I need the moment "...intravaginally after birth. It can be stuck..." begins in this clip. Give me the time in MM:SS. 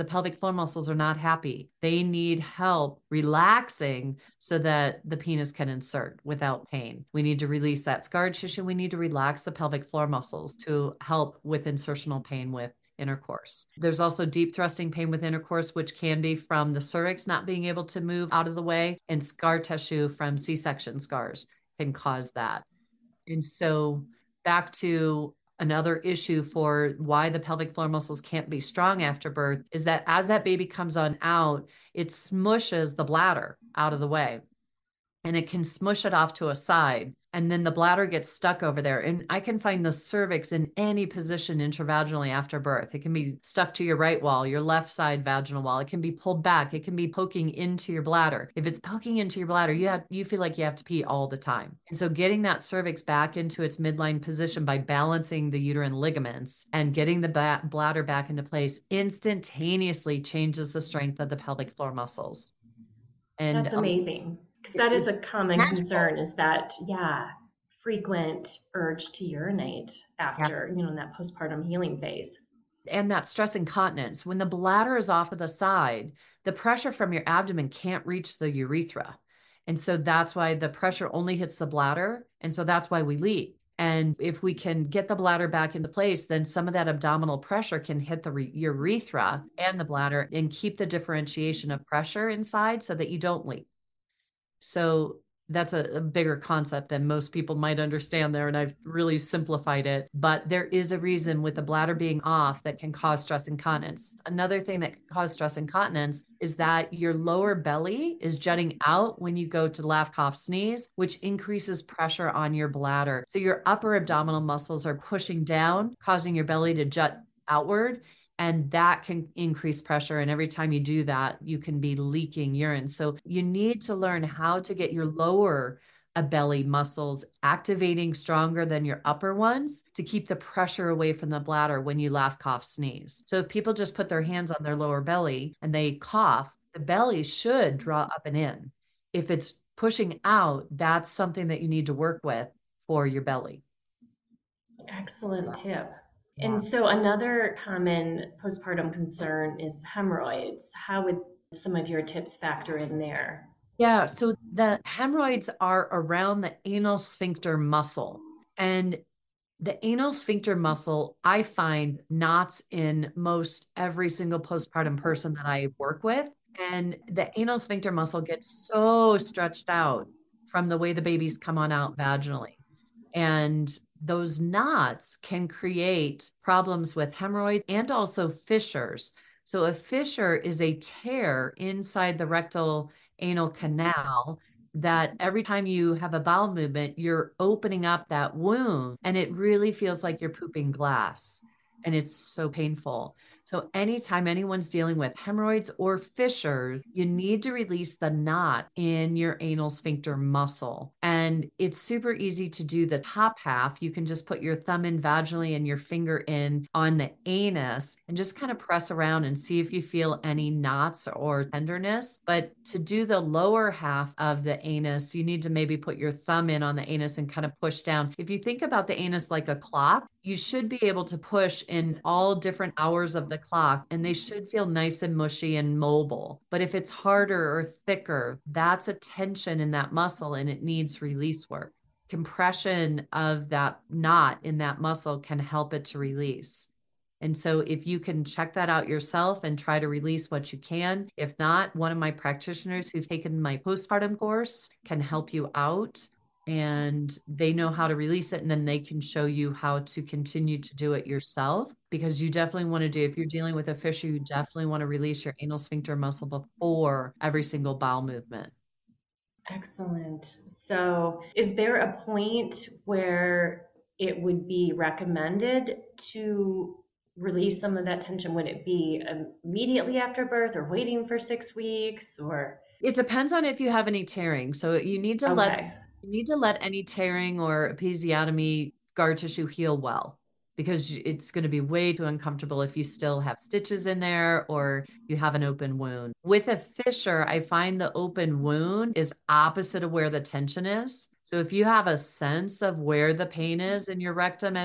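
00:41.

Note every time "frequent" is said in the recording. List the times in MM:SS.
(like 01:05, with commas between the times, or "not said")
01:07.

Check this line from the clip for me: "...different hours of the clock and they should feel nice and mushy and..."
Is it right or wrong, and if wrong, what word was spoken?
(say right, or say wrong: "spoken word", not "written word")
right.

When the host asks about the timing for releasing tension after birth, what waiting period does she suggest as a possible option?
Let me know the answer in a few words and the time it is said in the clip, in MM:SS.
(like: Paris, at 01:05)
6 weeks, at 04:31.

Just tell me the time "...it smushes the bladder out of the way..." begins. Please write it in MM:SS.
00:31.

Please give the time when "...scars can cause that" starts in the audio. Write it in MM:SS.
00:20.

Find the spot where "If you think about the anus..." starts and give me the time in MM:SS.
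03:38.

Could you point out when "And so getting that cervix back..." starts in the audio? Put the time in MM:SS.
00:51.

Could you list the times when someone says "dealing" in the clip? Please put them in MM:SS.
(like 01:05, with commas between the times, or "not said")
03:14, 04:13.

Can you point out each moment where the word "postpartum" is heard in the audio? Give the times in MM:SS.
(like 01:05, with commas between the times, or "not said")
01:11, 02:28, 02:44, 04:03.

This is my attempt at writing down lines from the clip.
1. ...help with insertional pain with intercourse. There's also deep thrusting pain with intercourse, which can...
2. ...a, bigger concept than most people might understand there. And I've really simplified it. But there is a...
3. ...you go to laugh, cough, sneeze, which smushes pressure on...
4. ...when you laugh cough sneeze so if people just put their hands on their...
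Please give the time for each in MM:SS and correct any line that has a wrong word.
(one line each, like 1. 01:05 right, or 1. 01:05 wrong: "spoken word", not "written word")
1. 00:11 right
2. 01:35 right
3. 01:49 wrong: "increases", not "smushes"
4. 02:11 right.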